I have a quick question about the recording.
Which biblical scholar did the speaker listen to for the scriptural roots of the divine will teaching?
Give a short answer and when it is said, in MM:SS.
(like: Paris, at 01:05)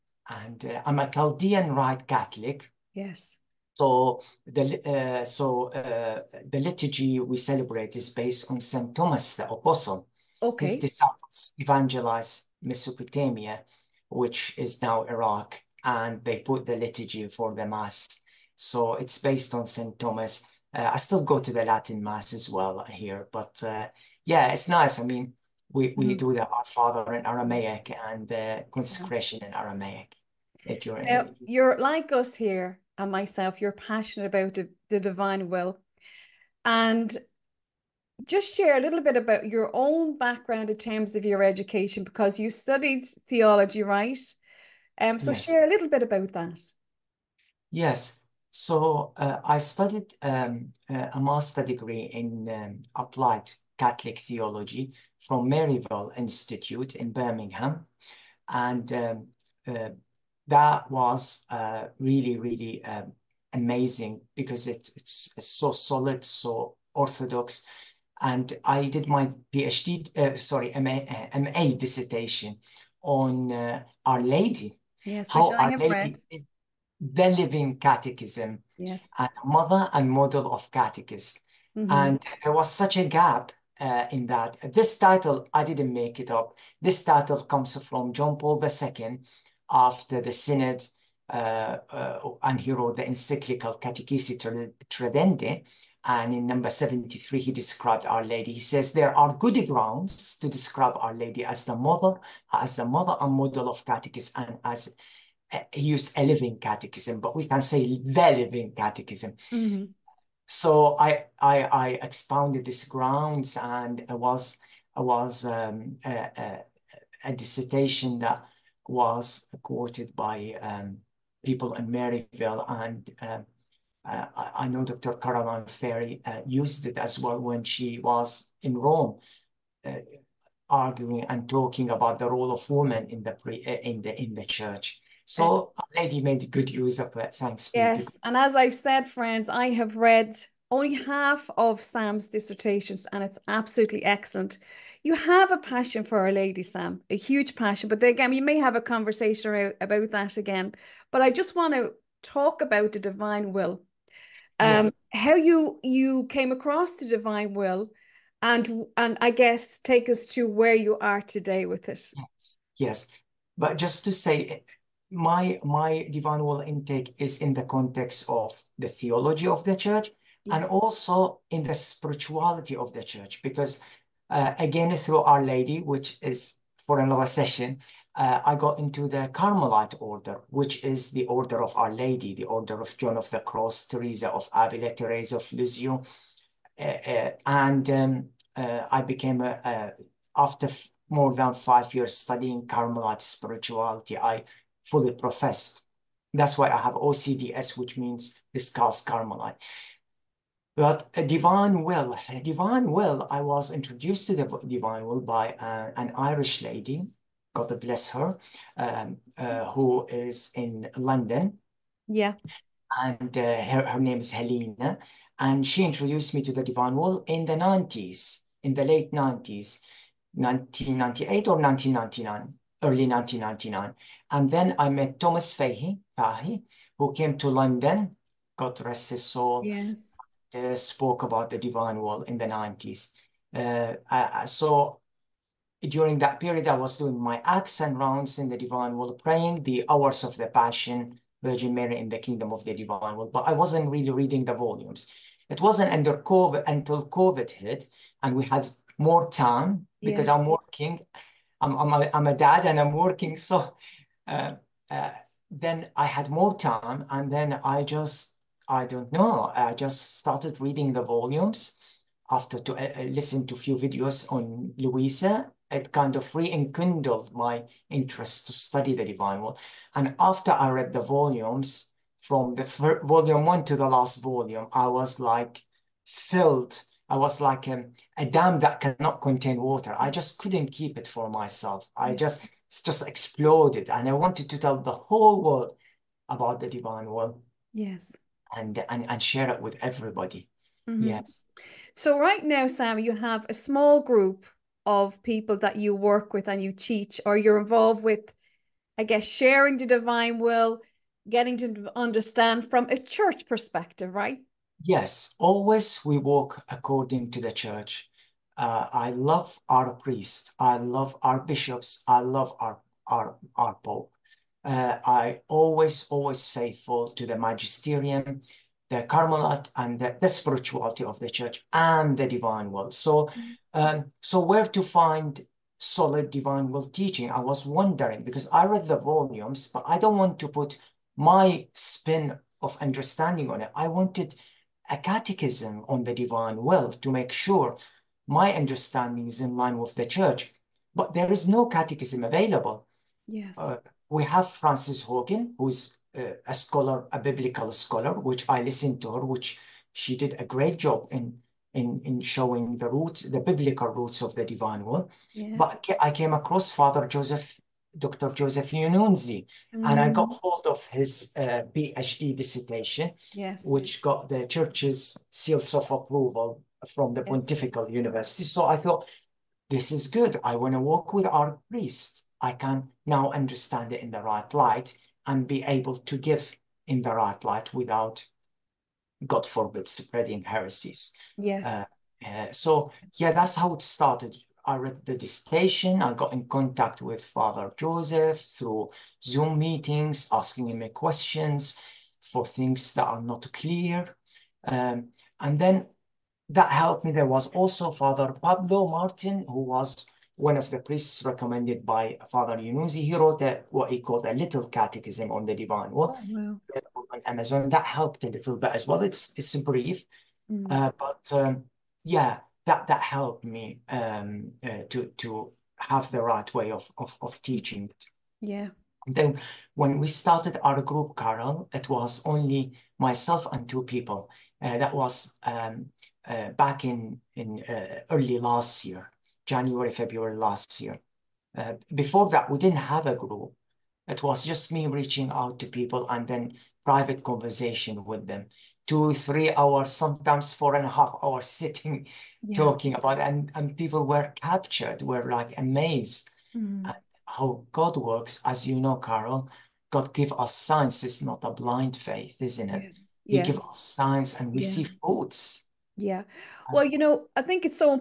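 Frances Hogan, at 05:44.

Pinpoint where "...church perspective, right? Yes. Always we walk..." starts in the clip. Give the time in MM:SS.
05:02.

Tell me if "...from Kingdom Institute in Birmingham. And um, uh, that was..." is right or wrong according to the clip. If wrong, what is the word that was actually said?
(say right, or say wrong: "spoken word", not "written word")
wrong: "Maryvale", not "Kingdom".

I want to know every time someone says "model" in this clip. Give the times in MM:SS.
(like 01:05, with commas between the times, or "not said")
01:20, 01:43.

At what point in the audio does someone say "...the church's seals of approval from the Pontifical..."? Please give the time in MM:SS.
06:04.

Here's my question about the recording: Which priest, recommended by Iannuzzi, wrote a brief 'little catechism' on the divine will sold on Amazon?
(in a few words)
Father Pablo Martin.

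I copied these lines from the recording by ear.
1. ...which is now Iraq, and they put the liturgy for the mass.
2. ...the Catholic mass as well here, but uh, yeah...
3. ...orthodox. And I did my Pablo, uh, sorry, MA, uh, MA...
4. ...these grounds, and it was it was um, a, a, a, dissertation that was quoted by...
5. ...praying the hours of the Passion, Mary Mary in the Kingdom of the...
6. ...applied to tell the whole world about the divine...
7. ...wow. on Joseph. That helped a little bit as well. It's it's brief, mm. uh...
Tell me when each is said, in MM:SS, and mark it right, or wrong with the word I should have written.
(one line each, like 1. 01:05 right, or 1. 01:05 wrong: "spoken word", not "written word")
1. 00:14 right
2. 00:21 wrong: "Latin", not "Catholic"
3. 01:06 wrong: "PhD", not "Pablo"
4. 01:52 right
5. 03:59 wrong: "Virgin", not "Mary"
6. 04:44 wrong: "wanted", not "applied"
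7. 06:46 wrong: "Amazon", not "Joseph".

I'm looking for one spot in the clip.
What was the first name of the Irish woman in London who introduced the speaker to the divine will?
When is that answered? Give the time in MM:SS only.
03:34.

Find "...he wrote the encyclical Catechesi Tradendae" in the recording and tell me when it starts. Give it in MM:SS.
01:32.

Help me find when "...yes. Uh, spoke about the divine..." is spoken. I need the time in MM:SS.
03:49.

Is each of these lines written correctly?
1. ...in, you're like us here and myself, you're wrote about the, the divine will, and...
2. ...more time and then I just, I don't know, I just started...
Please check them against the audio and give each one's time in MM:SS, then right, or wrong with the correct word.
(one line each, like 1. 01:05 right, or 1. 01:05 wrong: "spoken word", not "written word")
1. 00:31 wrong: "passionate", not "wrote"
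2. 04:16 right.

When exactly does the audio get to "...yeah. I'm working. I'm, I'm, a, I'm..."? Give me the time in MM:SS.
04:10.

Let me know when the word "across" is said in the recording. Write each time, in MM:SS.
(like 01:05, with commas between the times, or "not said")
02:36, 05:56.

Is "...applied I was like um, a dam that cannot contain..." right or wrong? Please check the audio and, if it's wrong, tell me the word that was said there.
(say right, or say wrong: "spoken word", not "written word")
wrong: "filled", not "applied".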